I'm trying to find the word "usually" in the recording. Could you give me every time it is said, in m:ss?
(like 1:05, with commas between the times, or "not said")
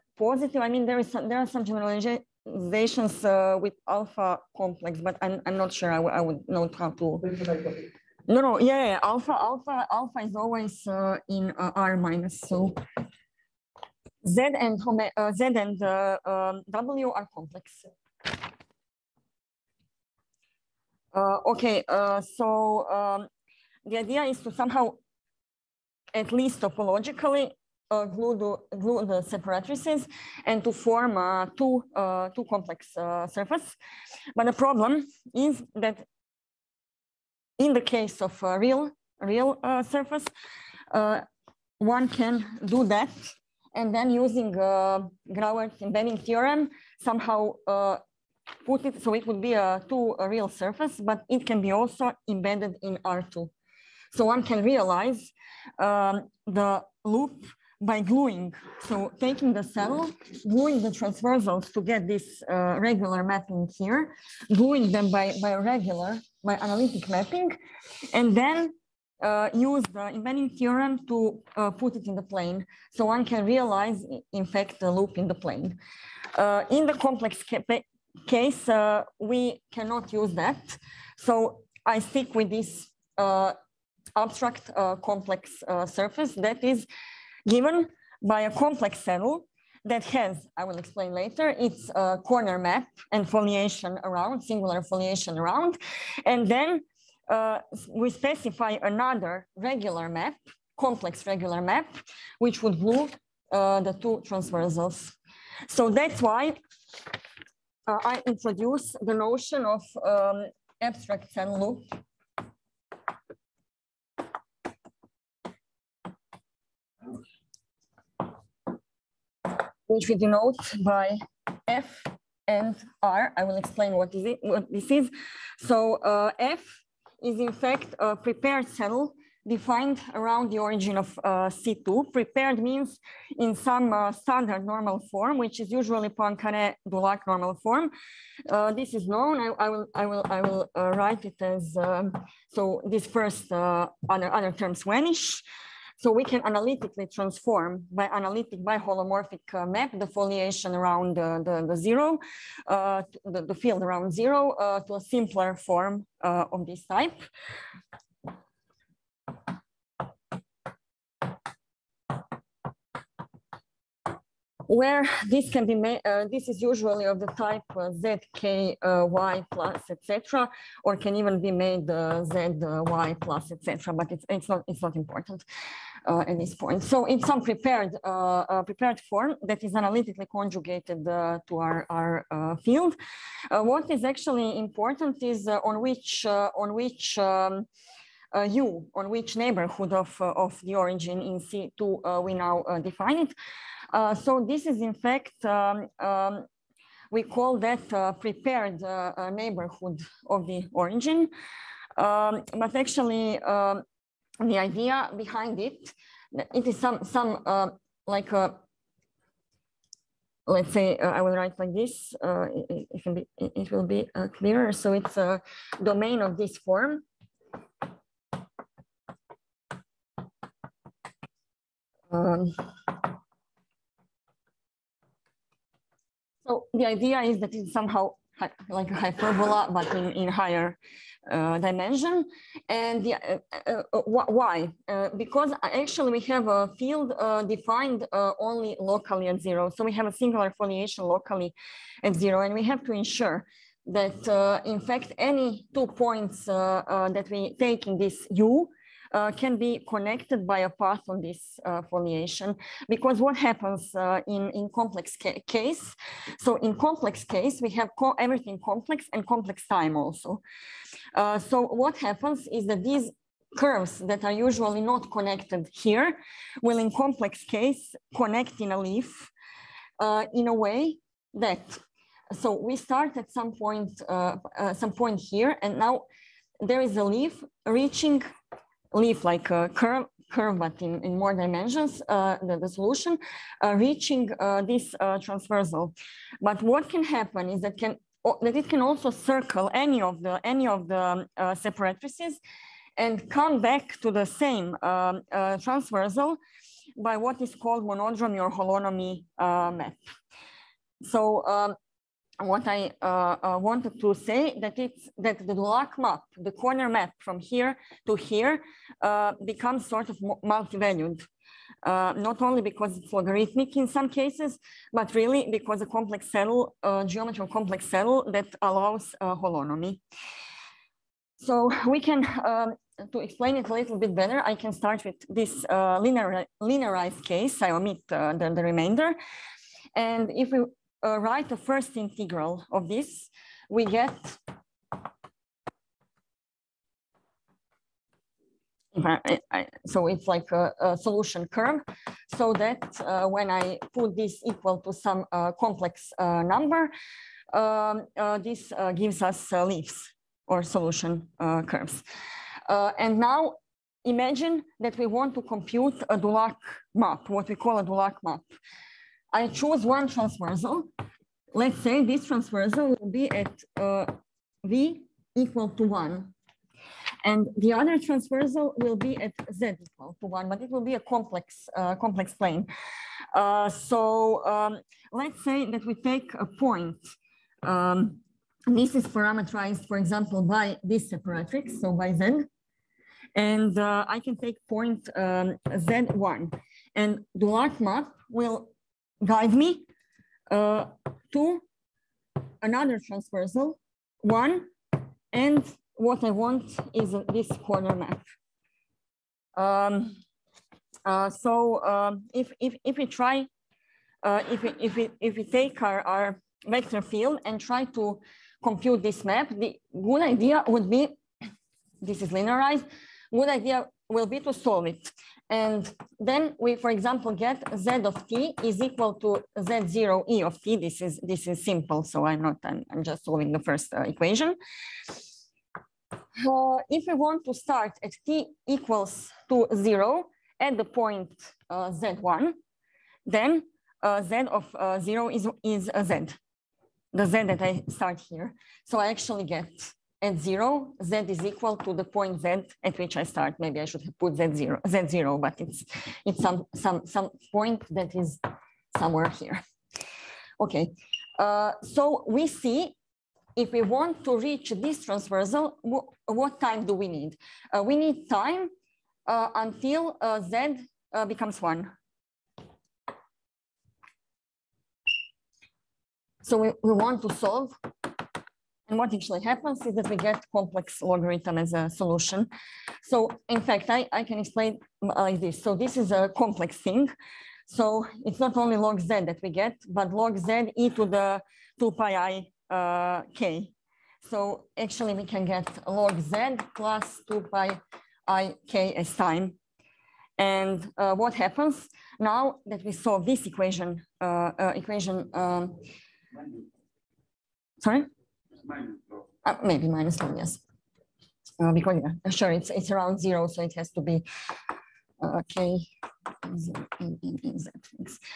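2:15, 2:46, 4:24.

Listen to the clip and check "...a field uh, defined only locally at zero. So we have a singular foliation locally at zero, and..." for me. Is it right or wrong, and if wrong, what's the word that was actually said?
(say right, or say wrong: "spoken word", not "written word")
right.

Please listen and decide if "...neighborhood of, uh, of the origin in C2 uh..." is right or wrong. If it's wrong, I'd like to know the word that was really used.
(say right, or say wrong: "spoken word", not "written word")
right.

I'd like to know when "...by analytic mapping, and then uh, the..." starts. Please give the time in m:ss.
1:06.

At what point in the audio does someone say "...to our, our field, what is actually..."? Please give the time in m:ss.
3:01.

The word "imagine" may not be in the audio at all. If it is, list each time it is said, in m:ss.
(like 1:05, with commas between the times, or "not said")
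5:54.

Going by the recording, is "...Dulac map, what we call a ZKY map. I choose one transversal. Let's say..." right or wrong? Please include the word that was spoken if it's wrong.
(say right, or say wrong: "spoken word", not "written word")
wrong: "Dulac", not "ZKY".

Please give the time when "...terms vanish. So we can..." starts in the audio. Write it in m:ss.
2:24.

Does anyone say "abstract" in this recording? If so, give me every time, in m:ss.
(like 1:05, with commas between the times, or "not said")
1:24, 1:50.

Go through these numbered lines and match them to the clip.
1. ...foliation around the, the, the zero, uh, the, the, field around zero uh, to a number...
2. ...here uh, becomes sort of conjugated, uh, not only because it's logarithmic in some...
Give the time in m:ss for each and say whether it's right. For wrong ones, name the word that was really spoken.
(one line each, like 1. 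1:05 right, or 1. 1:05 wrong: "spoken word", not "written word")
1. 2:30 wrong: "simpler", not "number"
2. 5:08 wrong: "multivalued", not "conjugated".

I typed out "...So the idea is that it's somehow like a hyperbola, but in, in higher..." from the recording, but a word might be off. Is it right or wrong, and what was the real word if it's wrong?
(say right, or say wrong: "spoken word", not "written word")
right.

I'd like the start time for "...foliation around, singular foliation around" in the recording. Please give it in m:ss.
1:33.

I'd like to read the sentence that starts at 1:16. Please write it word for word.
Uh, in the complex ca case, uh, we cannot use that.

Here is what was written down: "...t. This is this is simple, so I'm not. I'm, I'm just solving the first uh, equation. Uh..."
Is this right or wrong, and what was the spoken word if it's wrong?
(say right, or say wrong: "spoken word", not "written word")
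right.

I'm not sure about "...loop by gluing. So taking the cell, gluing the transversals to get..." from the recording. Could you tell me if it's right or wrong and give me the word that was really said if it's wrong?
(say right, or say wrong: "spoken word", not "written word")
right.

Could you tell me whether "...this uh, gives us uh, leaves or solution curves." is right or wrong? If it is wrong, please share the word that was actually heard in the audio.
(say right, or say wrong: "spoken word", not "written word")
right.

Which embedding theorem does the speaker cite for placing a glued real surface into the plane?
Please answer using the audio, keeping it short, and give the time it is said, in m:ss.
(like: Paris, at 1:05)
Grauert's embedding theorem, at 0:45.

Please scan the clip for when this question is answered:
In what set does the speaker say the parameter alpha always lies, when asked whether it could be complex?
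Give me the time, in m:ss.
0:11.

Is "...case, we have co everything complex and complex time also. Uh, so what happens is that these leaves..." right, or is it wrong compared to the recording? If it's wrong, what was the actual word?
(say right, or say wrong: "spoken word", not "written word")
wrong: "curves", not "leaves".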